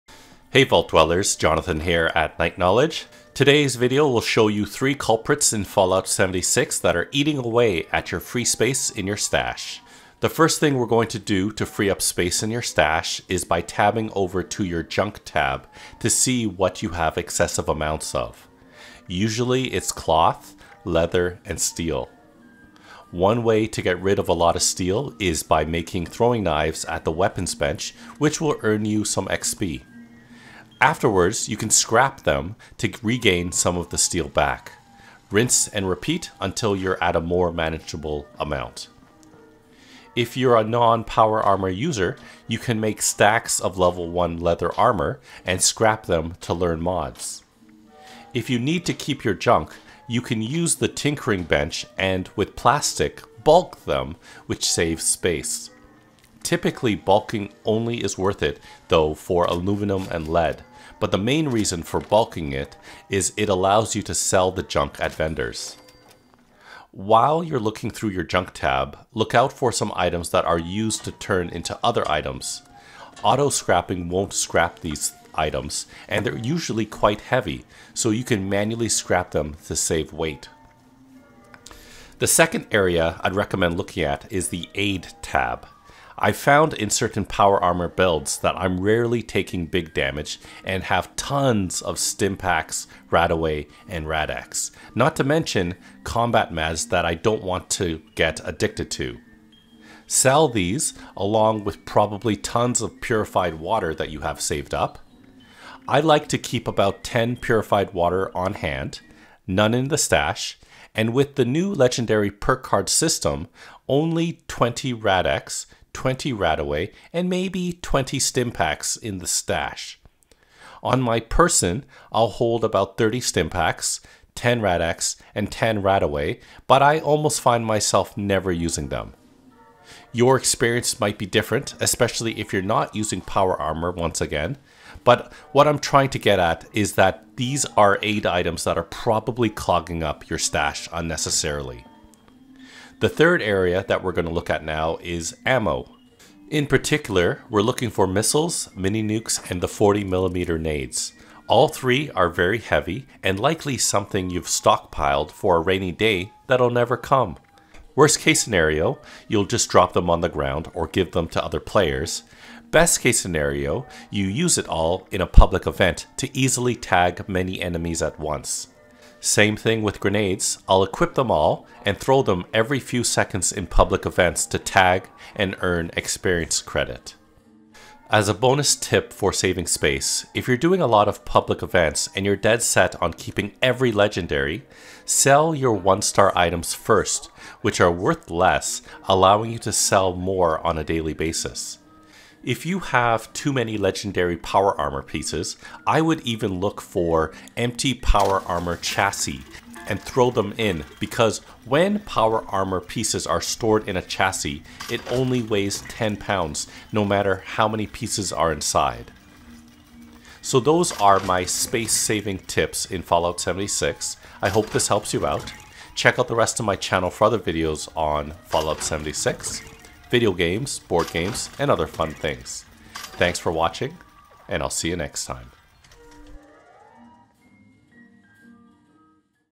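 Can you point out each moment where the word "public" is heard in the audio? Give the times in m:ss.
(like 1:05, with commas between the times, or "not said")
2:45, 2:53, 3:01.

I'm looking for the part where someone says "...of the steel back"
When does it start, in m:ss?
0:33.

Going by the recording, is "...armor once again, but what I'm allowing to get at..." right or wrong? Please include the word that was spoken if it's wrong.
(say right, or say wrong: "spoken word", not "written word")
wrong: "trying", not "allowing".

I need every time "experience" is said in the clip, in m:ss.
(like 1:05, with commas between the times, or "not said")
2:10, 2:55.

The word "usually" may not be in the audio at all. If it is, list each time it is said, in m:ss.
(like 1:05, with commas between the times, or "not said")
0:19, 1:16.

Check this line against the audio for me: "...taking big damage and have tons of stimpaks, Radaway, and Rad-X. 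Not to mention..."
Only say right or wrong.
right.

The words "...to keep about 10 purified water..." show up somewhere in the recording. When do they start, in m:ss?
1:46.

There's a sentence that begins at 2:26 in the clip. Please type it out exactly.
In particular, we're looking for missiles, mini nukes, and the 40mm nades.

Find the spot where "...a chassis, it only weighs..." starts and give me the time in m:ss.
3:23.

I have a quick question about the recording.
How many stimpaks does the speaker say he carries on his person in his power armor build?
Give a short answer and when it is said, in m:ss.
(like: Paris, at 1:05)
30, at 2:02.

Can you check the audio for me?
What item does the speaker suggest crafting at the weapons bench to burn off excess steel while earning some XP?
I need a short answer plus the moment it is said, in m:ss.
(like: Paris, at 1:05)
Throwing knives, at 0:26.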